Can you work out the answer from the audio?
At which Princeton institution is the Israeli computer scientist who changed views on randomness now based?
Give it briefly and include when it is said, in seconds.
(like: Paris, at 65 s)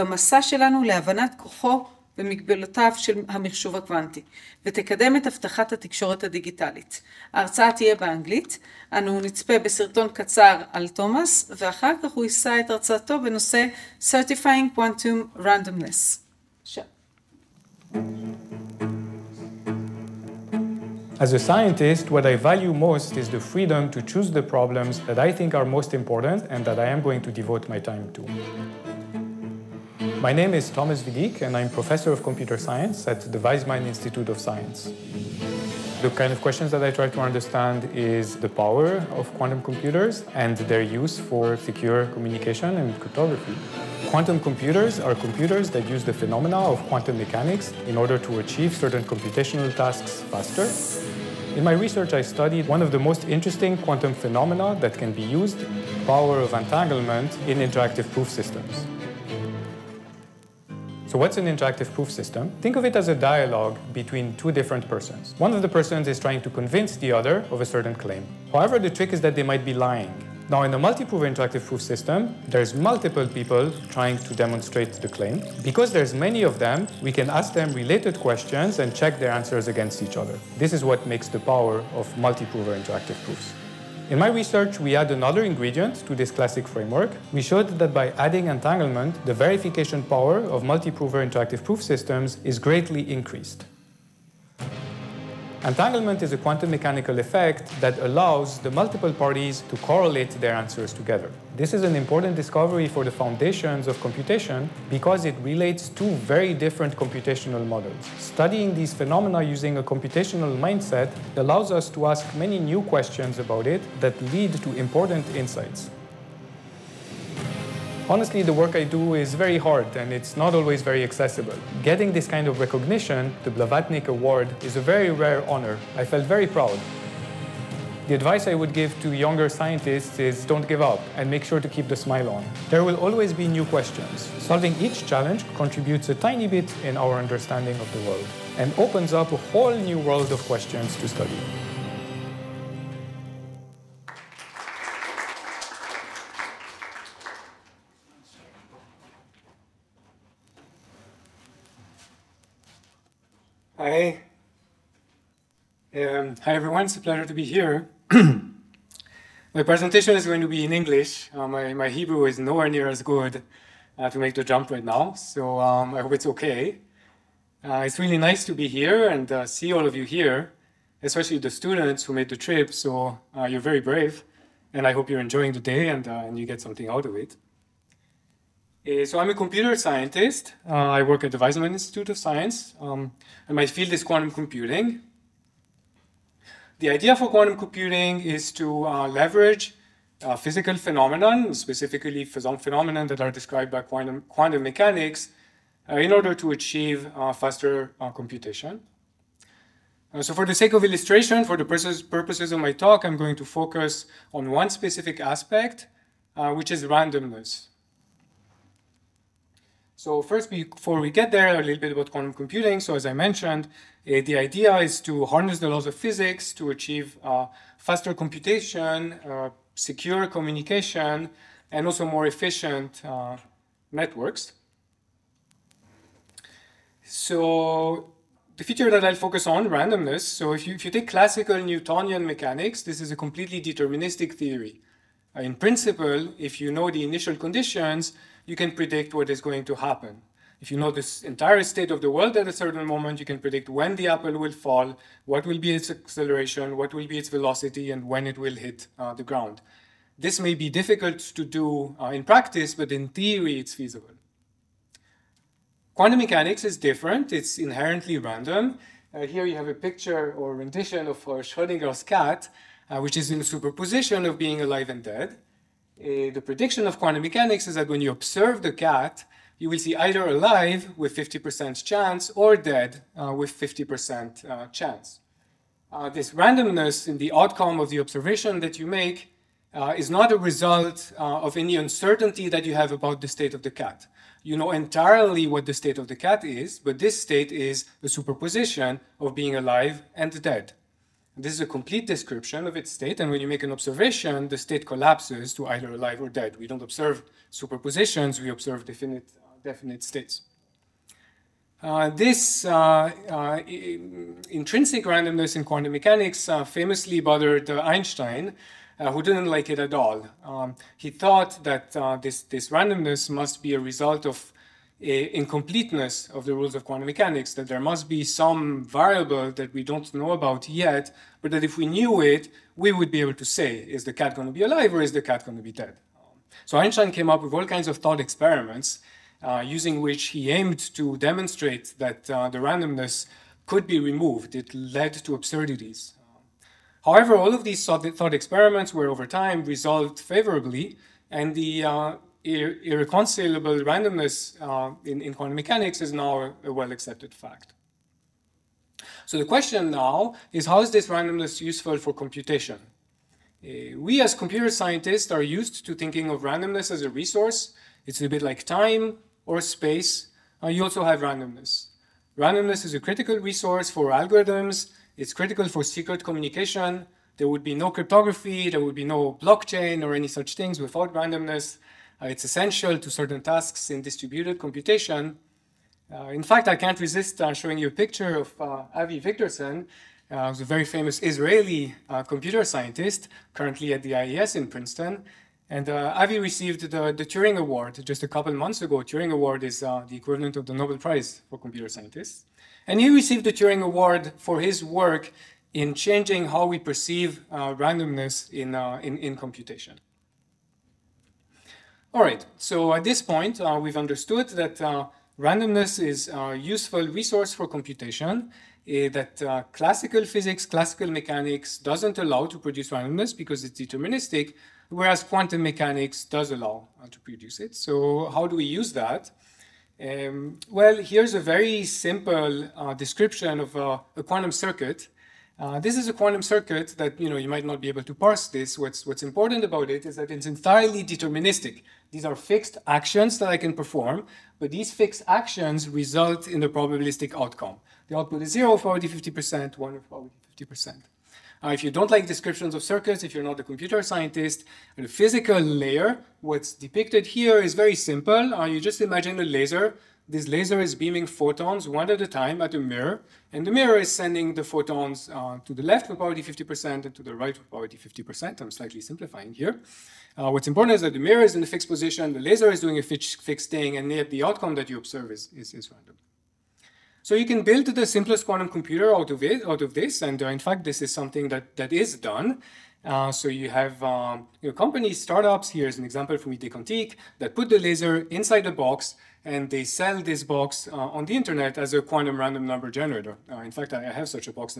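IAS, at 384 s.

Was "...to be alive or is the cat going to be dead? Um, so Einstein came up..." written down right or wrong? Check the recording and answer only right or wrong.
right.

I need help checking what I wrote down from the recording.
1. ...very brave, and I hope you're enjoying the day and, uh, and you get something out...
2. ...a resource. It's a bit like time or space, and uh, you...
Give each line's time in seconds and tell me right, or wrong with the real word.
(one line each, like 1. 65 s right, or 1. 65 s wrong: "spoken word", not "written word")
1. 173 s right
2. 357 s right.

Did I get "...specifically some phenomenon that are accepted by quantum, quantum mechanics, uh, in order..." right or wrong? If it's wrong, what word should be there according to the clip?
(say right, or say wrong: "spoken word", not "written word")
wrong: "described", not "accepted".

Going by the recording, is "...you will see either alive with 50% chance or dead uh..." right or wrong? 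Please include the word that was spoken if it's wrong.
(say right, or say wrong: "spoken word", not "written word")
right.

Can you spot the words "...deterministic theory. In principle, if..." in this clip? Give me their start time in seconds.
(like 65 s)
233 s.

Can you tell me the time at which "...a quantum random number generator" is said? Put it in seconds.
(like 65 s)
481 s.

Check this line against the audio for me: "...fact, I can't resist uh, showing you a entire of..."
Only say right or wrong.
wrong.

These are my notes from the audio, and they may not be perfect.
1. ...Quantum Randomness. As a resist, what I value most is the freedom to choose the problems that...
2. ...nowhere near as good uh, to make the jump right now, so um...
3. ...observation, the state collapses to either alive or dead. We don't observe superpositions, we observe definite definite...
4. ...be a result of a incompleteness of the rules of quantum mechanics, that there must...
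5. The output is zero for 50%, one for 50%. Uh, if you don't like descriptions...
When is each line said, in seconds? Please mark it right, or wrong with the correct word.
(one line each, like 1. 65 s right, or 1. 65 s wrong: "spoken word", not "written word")
1. 14 s wrong: "scientist", not "resist"
2. 162 s right
3. 293 s right
4. 313 s right
5. 438 s right.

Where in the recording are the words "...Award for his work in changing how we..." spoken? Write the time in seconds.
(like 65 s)
393 s.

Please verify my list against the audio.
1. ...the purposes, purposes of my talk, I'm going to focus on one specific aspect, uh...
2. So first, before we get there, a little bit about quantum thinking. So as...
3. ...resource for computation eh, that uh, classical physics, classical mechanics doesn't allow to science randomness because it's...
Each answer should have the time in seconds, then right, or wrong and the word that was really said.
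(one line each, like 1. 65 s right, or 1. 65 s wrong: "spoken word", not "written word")
1. 201 s right
2. 209 s wrong: "computing", not "thinking"
3. 407 s wrong: "produce", not "science".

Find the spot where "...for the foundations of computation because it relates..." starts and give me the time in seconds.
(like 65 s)
102 s.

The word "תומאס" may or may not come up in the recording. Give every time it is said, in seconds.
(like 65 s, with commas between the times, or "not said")
10 s.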